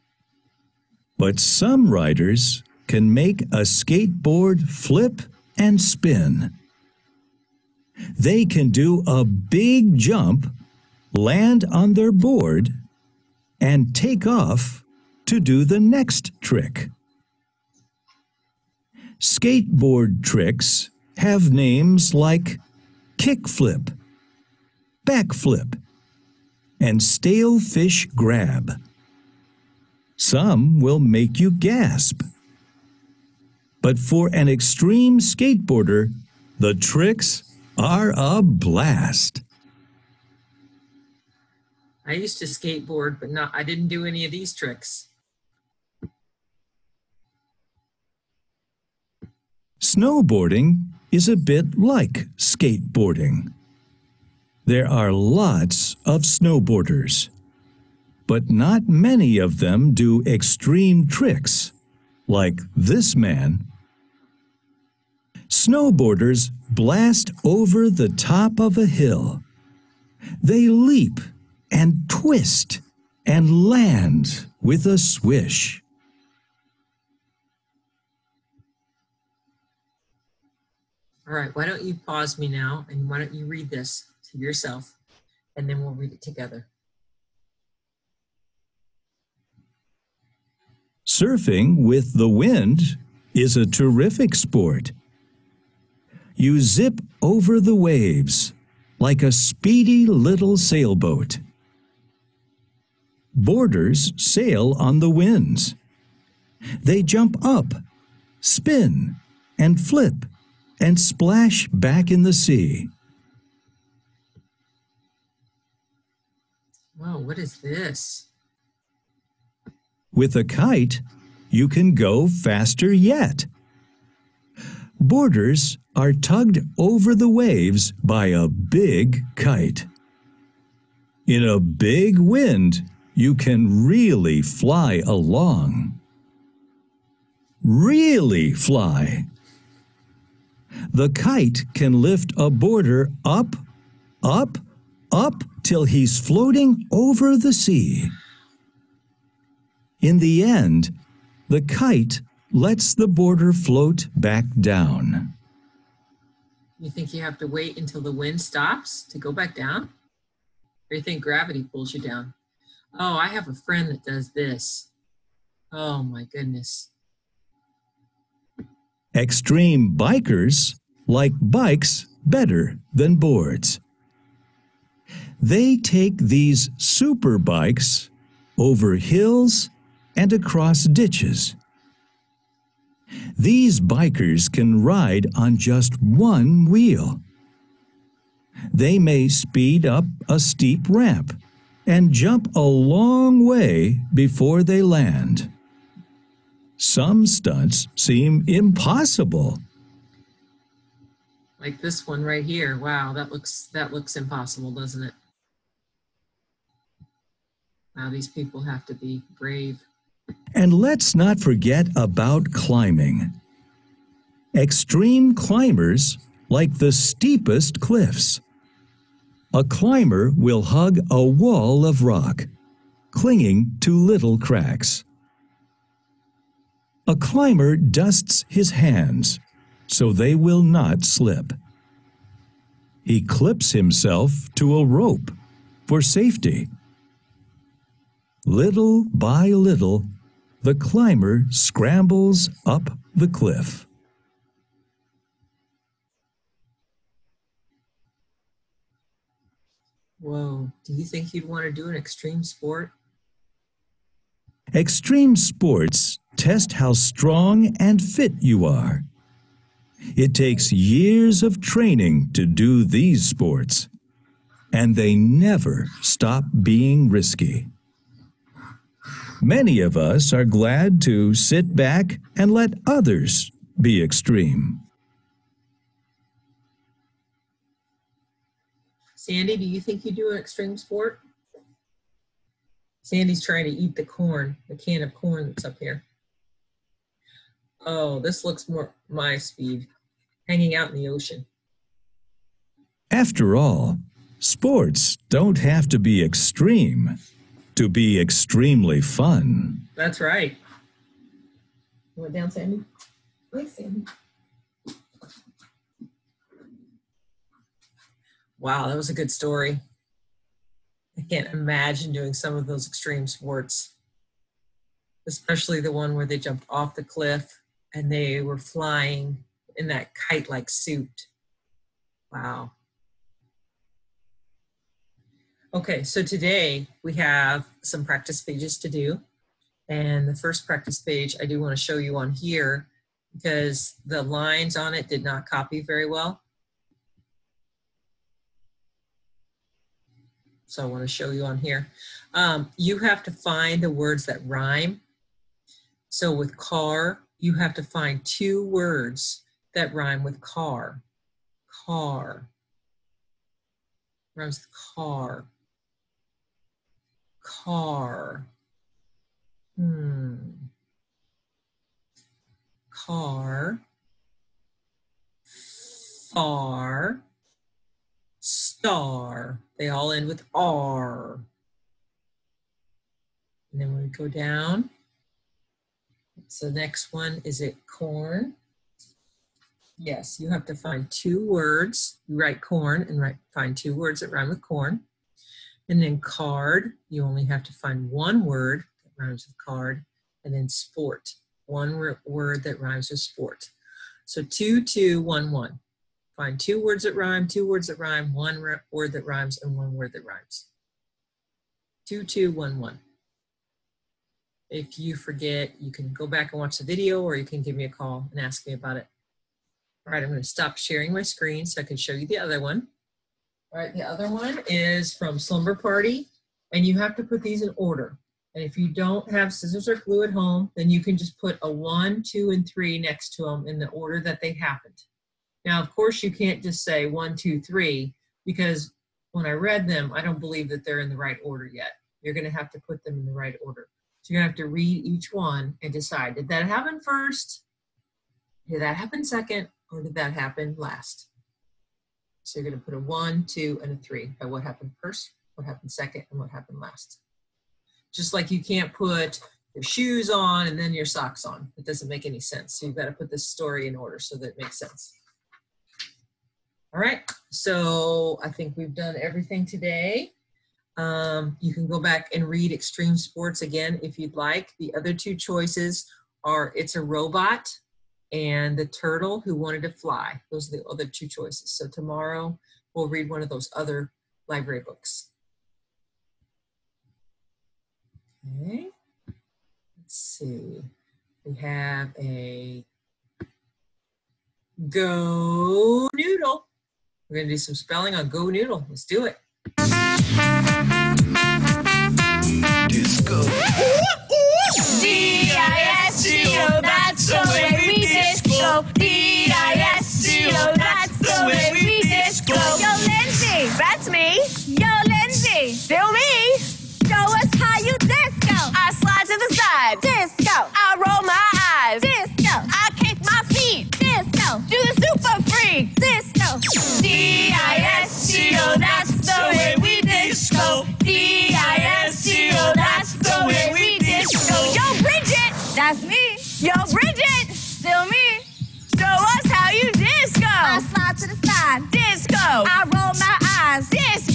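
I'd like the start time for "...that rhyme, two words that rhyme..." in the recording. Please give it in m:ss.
6:37.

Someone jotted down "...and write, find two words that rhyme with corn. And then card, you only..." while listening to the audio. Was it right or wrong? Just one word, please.
right.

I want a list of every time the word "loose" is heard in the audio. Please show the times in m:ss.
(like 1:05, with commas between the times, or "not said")
not said.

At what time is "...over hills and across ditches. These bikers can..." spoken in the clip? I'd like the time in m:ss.
2:58.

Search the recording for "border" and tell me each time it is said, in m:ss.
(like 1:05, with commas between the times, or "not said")
2:22, 2:33.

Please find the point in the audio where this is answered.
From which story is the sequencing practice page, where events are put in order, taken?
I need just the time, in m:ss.
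6:55.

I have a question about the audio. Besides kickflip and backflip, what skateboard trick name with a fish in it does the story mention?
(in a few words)
Stale fish grab.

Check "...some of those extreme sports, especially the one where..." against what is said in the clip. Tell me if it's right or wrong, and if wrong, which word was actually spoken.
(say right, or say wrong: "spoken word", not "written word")
right.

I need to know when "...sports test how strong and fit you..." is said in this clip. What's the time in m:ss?
4:15.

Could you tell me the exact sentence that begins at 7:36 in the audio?
All right, so I think we've done everything today.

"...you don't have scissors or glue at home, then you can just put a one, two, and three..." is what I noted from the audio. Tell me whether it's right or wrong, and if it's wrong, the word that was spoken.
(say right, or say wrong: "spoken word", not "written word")
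right.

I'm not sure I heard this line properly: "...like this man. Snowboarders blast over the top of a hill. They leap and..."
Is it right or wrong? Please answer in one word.
right.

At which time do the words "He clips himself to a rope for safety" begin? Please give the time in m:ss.
3:53.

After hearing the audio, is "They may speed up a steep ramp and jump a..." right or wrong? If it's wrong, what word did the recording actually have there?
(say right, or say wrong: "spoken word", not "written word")
right.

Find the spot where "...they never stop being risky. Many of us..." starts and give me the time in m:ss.
4:24.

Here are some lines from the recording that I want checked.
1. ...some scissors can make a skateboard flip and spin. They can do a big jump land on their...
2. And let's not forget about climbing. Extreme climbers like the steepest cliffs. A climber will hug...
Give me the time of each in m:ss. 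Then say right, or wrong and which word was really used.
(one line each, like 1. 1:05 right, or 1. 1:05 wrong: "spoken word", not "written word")
1. 0:01 wrong: "riders", not "scissors"
2. 3:30 right.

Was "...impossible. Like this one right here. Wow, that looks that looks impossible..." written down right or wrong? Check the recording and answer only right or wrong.
right.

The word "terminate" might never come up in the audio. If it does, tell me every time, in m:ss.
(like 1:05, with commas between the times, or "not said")
not said.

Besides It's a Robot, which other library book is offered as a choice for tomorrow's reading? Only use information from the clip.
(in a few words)
The Turtle Who Wanted to Fly.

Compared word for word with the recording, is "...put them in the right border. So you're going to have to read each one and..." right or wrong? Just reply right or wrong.
wrong.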